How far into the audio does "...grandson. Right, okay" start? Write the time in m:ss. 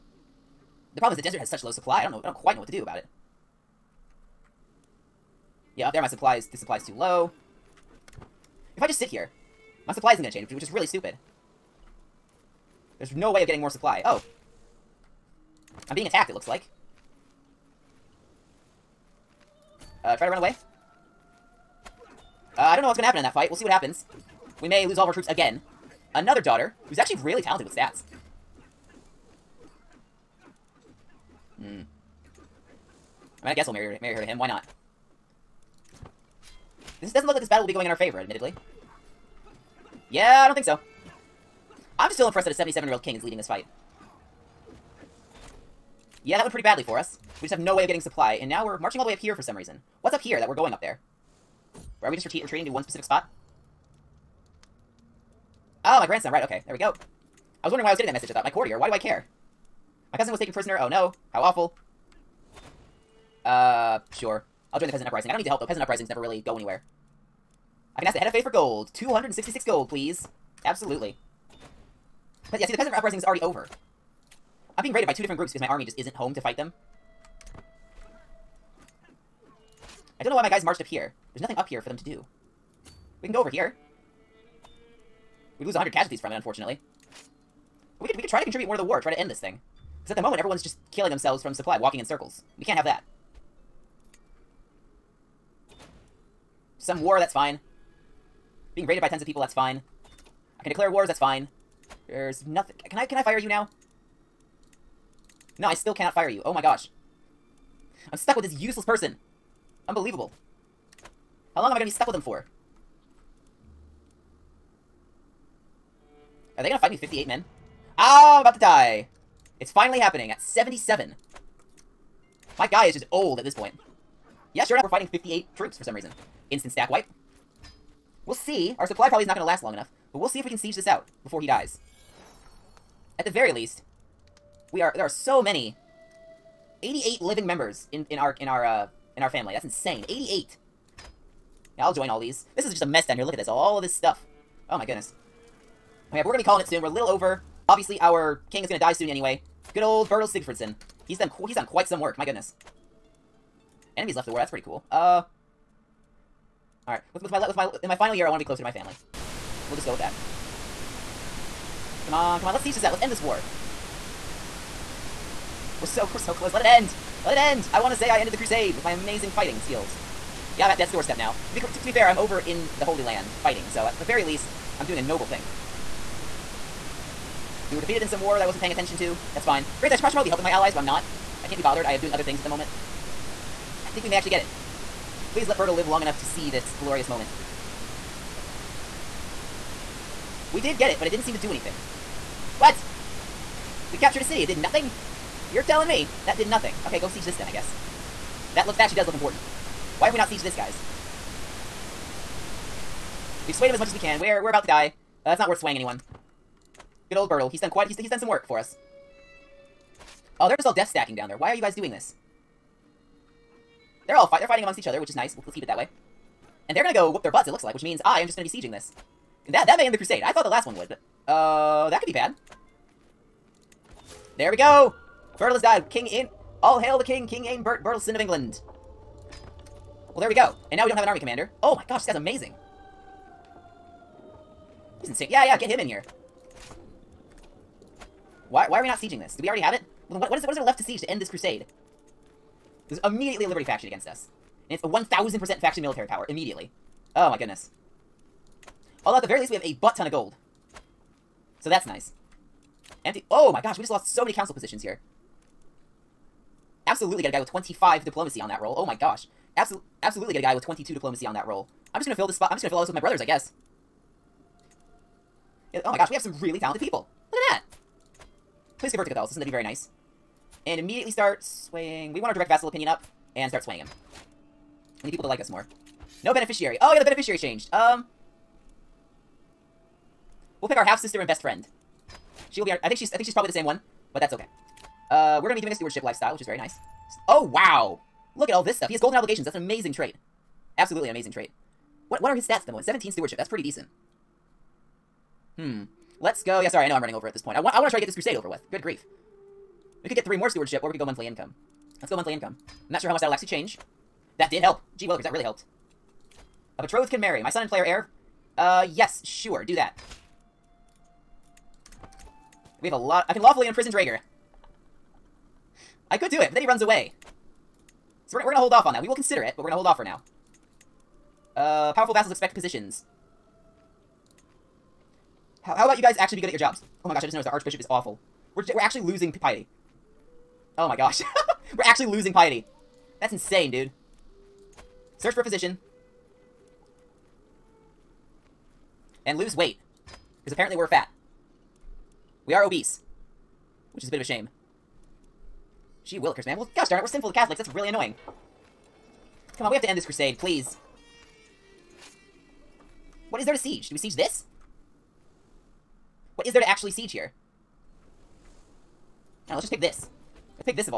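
0:56.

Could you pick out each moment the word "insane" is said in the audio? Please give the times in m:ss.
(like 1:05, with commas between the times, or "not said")
2:19, 3:55, 5:33.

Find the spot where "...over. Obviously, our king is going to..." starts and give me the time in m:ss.
2:27.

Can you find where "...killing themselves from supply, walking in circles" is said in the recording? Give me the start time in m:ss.
1:30.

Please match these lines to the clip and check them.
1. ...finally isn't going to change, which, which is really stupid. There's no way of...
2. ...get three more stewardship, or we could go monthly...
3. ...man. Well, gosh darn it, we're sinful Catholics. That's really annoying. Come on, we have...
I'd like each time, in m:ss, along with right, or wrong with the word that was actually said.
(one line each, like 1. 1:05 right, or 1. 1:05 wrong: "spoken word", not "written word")
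1. 0:09 wrong: "supply", not "finally"
2. 5:00 right
3. 5:46 right.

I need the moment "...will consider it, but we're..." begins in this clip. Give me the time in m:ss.
5:19.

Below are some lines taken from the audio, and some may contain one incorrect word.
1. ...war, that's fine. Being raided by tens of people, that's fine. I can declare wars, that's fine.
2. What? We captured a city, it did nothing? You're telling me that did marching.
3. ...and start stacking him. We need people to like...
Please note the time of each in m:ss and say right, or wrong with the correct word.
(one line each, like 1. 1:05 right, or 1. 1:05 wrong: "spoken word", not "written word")
1. 1:37 right
2. 3:12 wrong: "nothing", not "marching"
3. 4:33 wrong: "swaying", not "stacking".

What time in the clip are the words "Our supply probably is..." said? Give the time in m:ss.
2:08.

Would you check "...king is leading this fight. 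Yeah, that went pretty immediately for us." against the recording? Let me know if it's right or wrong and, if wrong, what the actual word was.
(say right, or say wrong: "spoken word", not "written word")
wrong: "badly", not "immediately".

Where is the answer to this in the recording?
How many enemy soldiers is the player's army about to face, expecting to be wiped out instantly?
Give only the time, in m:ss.
2:05.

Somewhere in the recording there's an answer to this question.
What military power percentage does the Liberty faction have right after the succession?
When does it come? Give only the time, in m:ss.
4:04.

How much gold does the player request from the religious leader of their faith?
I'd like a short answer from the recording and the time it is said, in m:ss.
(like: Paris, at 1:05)
266 gold, at 1:08.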